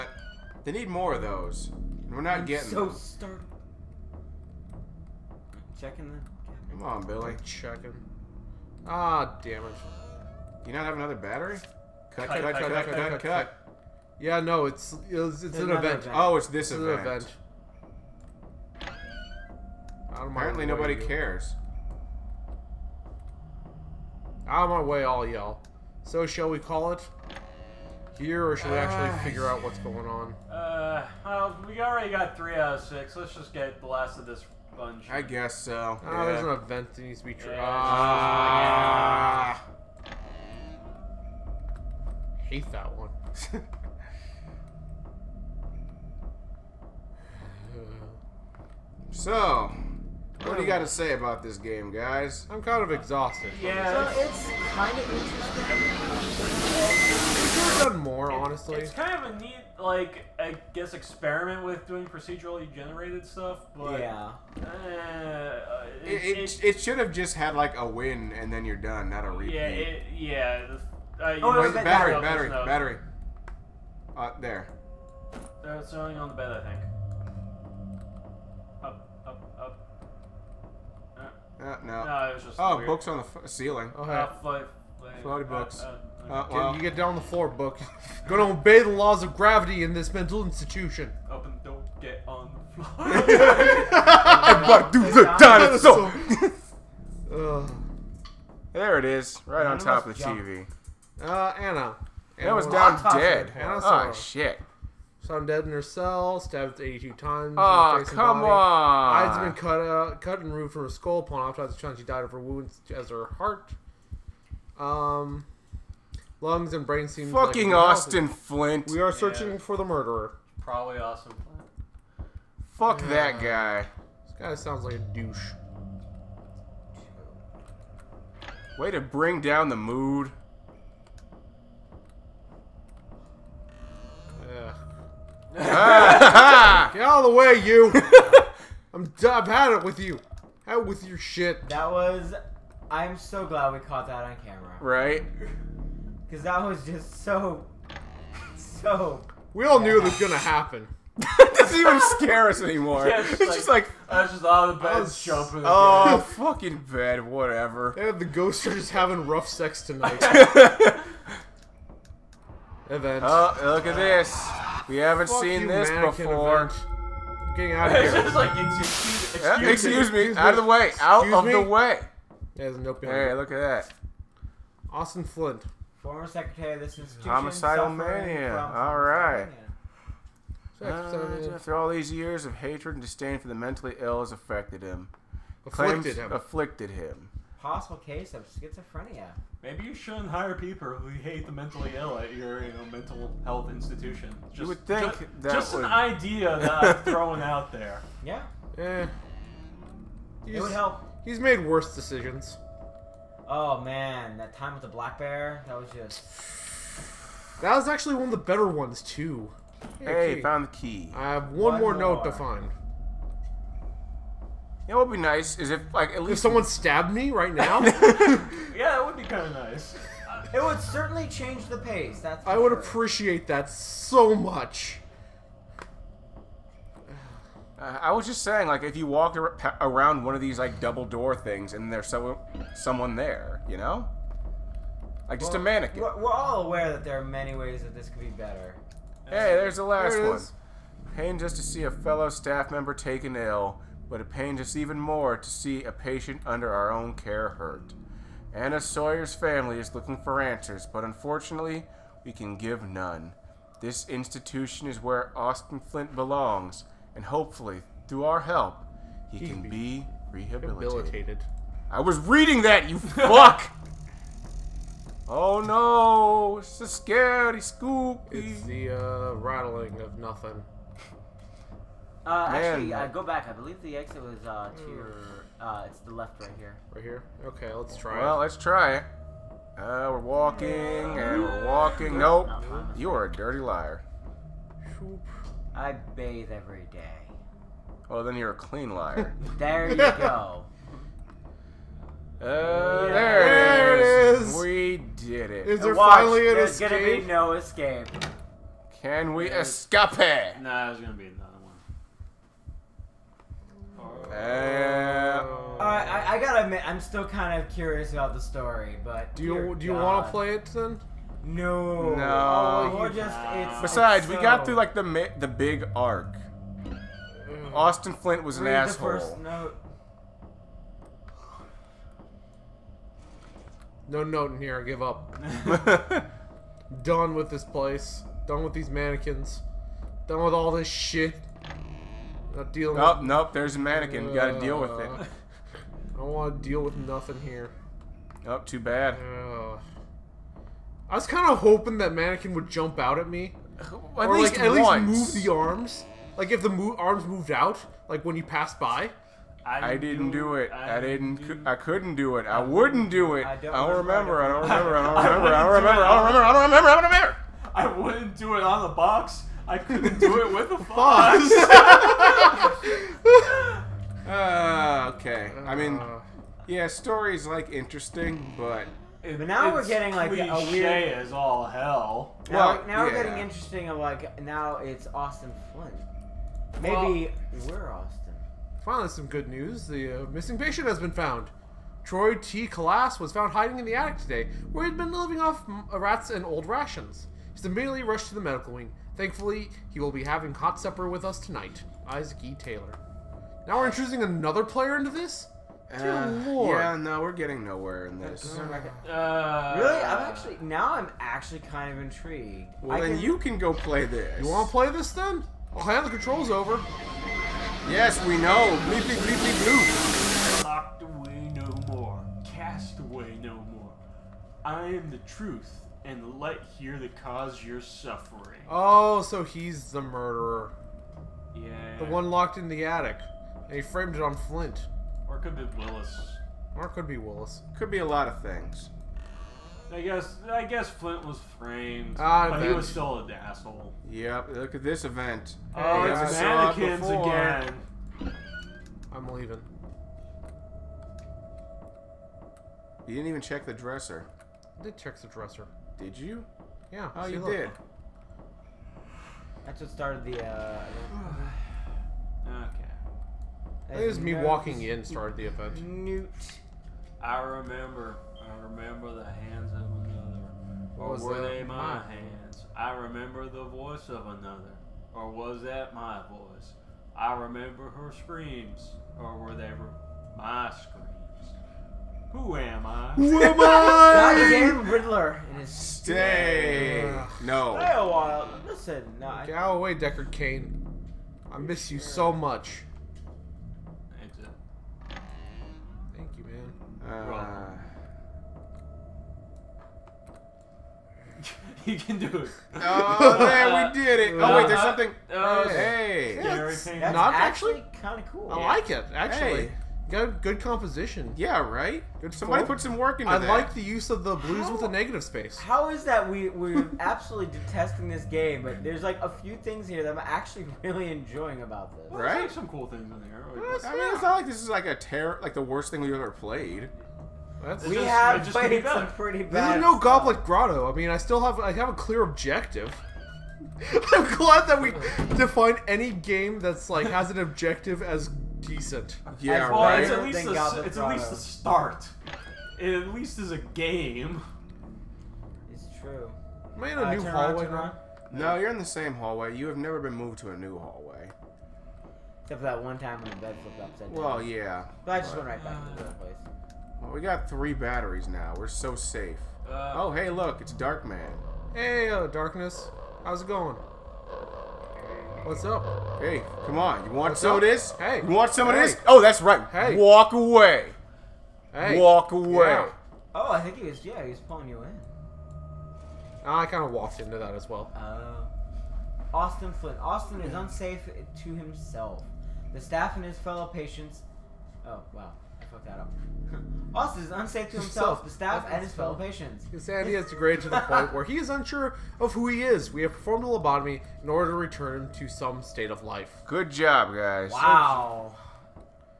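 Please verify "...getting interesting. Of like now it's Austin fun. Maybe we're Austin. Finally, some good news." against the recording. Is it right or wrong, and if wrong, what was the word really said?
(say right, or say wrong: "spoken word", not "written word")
right.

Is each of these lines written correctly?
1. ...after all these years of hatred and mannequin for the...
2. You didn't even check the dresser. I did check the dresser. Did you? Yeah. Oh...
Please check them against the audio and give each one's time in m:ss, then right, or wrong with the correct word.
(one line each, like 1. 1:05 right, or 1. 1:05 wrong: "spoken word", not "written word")
1. 3:01 wrong: "disdain", not "mannequin"
2. 7:23 right.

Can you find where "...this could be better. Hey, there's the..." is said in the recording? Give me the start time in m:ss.
3:57.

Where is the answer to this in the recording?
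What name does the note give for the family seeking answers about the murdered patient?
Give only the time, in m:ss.
4:08.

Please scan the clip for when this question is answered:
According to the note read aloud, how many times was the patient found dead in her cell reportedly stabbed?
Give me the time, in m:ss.
1:46.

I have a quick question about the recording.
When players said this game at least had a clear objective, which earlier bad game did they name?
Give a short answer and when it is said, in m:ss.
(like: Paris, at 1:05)
Goblet Grotto, at 8:39.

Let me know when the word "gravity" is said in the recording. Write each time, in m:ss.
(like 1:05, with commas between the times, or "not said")
1:29.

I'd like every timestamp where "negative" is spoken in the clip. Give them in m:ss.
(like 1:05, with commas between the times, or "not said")
8:24.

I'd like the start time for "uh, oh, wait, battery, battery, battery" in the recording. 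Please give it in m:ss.
1:11.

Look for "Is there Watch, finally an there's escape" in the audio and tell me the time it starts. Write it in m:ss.
4:55.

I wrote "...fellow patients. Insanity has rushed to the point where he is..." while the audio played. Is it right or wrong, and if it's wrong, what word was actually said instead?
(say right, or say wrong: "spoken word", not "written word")
wrong: "degraded", not "rushed".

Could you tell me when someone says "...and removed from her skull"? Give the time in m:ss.
1:50.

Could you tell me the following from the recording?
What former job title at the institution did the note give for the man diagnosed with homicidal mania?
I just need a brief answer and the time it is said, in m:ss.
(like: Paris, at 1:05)
Secretary, at 2:56.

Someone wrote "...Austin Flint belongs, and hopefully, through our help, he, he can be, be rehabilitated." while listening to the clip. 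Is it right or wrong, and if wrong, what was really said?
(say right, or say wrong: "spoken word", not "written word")
right.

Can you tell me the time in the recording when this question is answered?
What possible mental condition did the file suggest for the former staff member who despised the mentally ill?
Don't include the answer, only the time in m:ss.
3:08.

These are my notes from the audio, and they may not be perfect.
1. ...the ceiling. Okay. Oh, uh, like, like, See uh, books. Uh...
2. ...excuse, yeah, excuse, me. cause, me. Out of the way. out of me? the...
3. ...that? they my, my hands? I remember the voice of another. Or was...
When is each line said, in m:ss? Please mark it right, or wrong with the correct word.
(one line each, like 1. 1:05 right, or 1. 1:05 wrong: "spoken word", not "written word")
1. 1:23 wrong: "Floaty", not "See"
2. 2:49 wrong: "excuse", not "cause"
3. 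7:41 right.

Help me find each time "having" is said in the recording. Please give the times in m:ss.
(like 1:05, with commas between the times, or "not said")
2:38, 6:30.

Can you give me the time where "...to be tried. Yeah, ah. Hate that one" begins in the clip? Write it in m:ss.
0:37.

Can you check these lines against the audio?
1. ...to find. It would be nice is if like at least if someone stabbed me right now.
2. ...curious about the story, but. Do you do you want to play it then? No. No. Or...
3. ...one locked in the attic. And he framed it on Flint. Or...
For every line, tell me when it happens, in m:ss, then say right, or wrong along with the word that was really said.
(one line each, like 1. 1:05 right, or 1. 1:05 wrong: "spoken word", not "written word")
1. 3:32 right
2. 5:07 right
3. 7:02 right.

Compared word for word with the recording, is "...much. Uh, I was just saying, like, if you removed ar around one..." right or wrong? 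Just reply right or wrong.
wrong.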